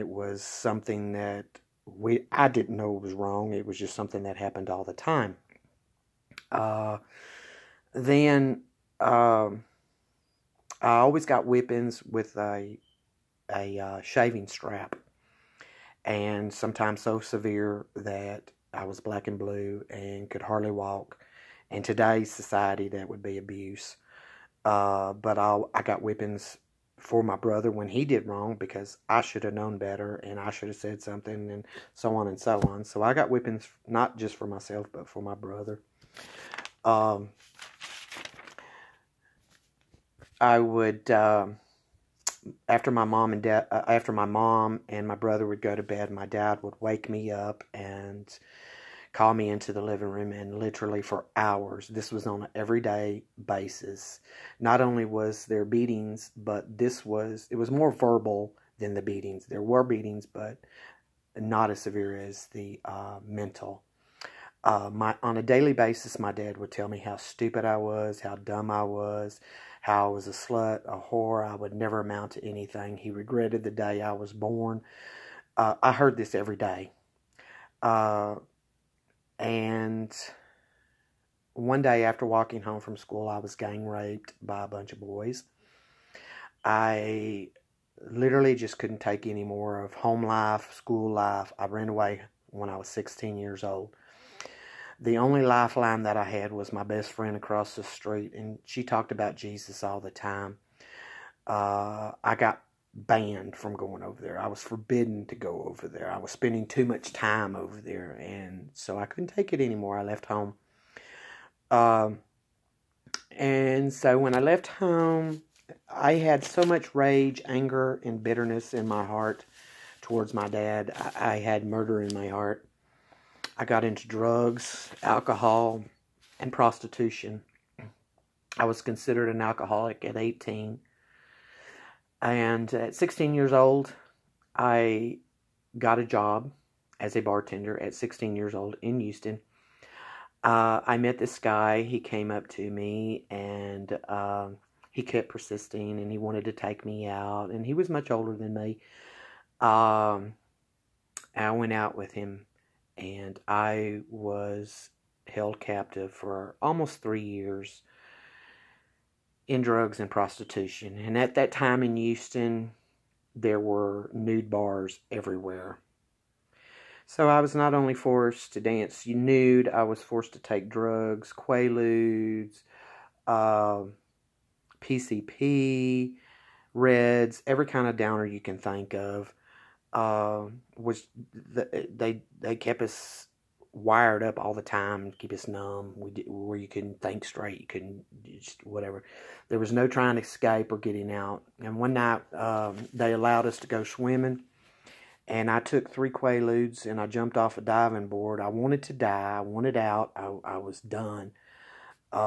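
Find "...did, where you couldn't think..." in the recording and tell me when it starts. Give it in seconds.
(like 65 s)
186 s.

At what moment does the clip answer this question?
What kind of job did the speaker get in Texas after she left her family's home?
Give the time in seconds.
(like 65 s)
137 s.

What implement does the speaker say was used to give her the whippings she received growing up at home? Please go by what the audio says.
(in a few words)
shaving strap.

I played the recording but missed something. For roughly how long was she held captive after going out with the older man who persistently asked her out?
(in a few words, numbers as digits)
almost 3 years.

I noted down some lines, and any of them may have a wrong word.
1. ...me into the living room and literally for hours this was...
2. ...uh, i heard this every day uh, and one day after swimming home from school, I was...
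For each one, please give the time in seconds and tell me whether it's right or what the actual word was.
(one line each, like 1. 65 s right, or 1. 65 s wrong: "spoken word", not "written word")
1. 49 s right
2. 75 s wrong: "walking", not "swimming".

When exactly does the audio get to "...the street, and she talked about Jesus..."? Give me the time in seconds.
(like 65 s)
97 s.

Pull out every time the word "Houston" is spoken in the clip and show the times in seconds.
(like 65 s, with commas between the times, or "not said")
138 s, 161 s.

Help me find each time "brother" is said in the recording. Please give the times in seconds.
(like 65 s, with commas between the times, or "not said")
27 s, 35 s, 45 s.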